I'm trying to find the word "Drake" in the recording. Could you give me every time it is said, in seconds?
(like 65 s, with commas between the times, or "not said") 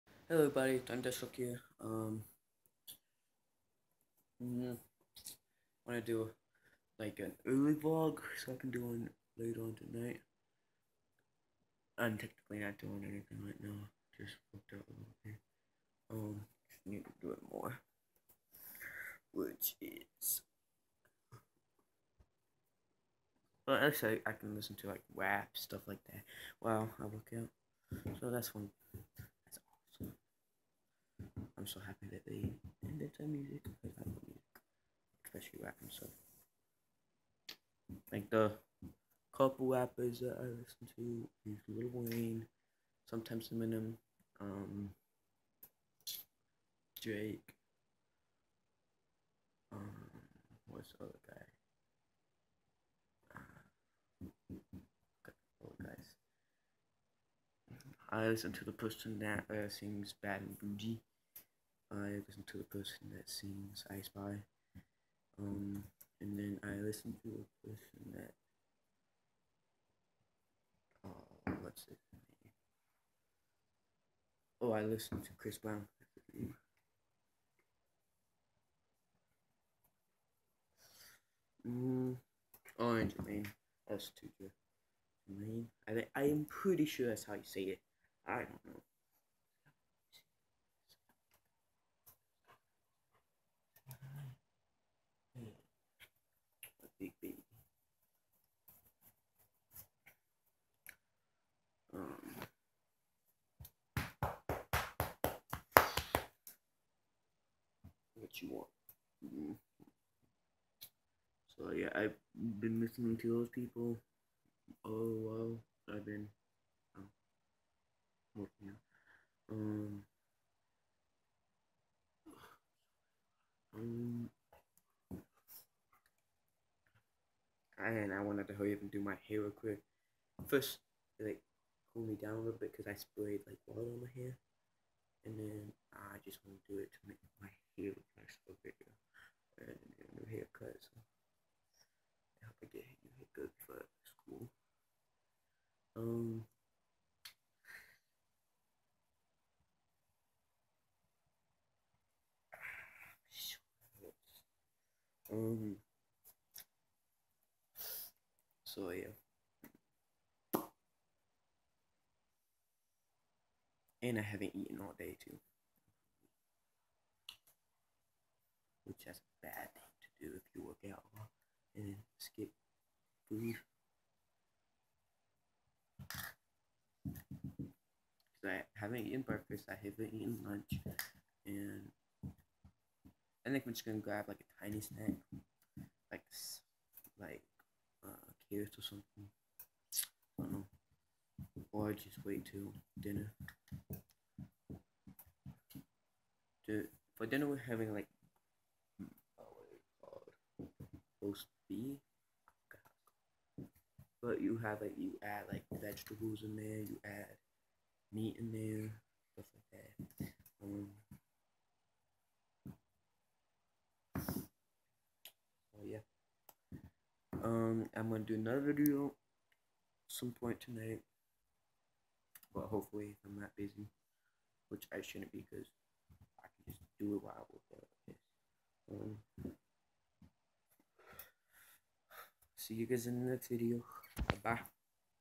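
46 s.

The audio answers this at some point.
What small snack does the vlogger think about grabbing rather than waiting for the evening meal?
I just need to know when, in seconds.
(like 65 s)
188 s.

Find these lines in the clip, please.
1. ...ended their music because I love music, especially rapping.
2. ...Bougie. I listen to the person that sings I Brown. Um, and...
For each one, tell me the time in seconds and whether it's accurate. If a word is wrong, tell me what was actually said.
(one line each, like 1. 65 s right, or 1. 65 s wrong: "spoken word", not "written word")
1. 32 s right
2. 60 s wrong: "Spy", not "Brown".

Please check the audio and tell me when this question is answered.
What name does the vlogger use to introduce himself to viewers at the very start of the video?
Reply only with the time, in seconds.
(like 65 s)
1 s.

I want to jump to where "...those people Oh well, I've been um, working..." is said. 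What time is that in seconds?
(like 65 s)
113 s.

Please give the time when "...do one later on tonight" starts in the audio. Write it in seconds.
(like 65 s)
8 s.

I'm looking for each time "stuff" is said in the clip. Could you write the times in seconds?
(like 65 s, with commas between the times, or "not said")
25 s, 209 s.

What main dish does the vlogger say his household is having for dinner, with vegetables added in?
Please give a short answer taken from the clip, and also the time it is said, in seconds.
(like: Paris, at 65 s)
roast beef, at 201 s.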